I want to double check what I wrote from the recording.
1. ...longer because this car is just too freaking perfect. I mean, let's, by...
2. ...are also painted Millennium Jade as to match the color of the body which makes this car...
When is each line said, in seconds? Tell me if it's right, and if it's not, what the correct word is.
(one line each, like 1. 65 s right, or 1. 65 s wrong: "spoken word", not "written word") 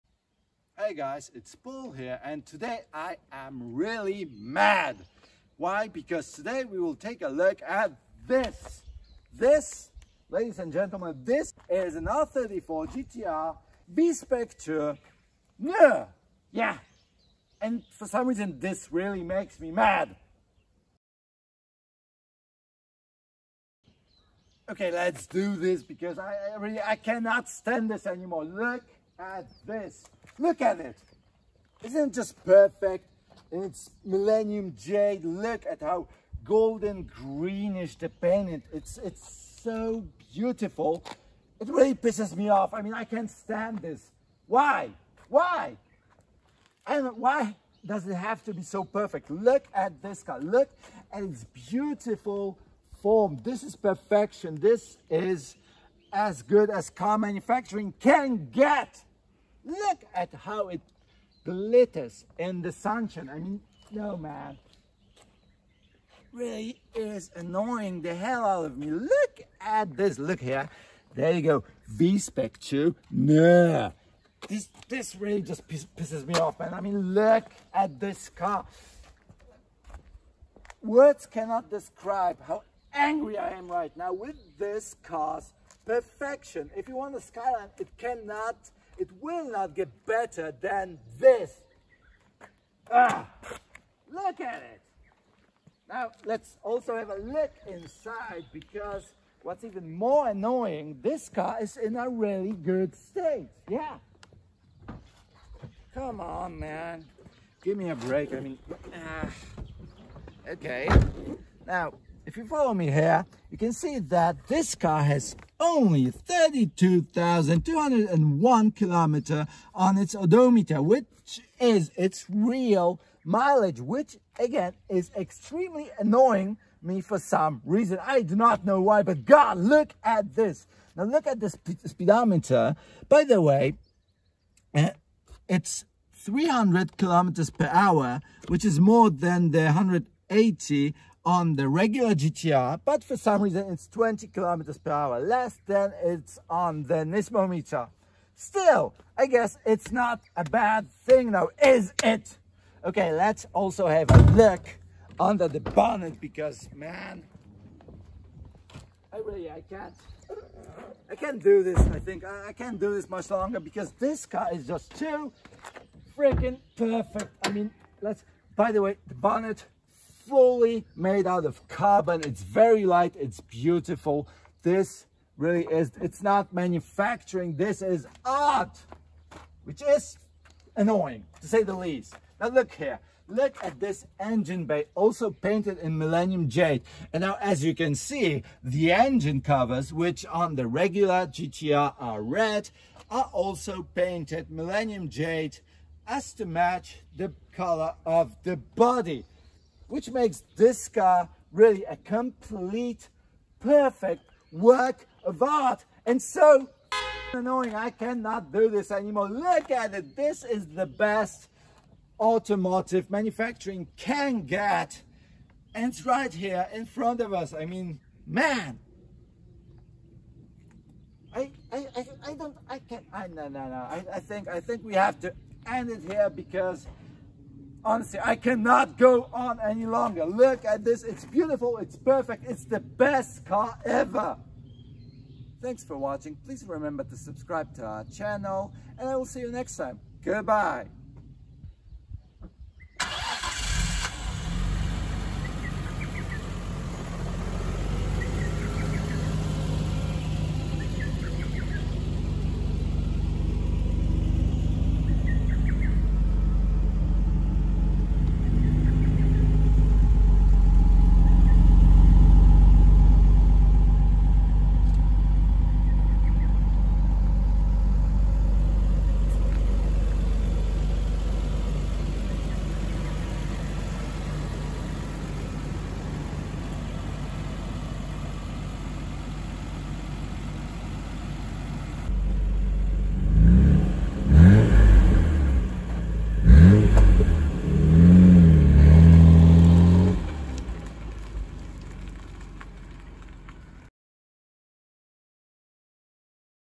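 1. 163 s right
2. 193 s right.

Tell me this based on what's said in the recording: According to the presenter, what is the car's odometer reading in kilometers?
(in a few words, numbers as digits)
32,201.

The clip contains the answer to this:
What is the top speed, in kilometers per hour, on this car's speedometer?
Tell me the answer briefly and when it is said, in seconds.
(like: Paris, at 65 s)
300, at 136 s.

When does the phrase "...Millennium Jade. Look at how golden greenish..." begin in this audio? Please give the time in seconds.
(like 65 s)
34 s.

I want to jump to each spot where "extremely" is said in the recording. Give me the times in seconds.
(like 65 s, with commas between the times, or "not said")
125 s.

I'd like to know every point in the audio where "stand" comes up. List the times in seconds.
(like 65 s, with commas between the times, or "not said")
27 s, 43 s.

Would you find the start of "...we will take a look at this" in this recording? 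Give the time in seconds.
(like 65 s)
6 s.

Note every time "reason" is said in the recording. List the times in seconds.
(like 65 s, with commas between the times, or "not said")
18 s, 127 s, 143 s.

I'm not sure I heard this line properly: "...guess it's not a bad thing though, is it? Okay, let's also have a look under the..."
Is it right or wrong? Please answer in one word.
right.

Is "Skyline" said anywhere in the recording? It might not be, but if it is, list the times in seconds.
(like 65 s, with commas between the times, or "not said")
87 s.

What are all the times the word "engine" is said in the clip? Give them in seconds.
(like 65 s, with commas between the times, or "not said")
184 s, 188 s.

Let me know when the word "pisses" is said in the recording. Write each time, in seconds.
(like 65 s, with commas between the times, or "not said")
41 s, 75 s.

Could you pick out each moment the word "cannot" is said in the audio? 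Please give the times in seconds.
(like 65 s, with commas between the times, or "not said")
26 s, 81 s, 87 s, 207 s, 228 s.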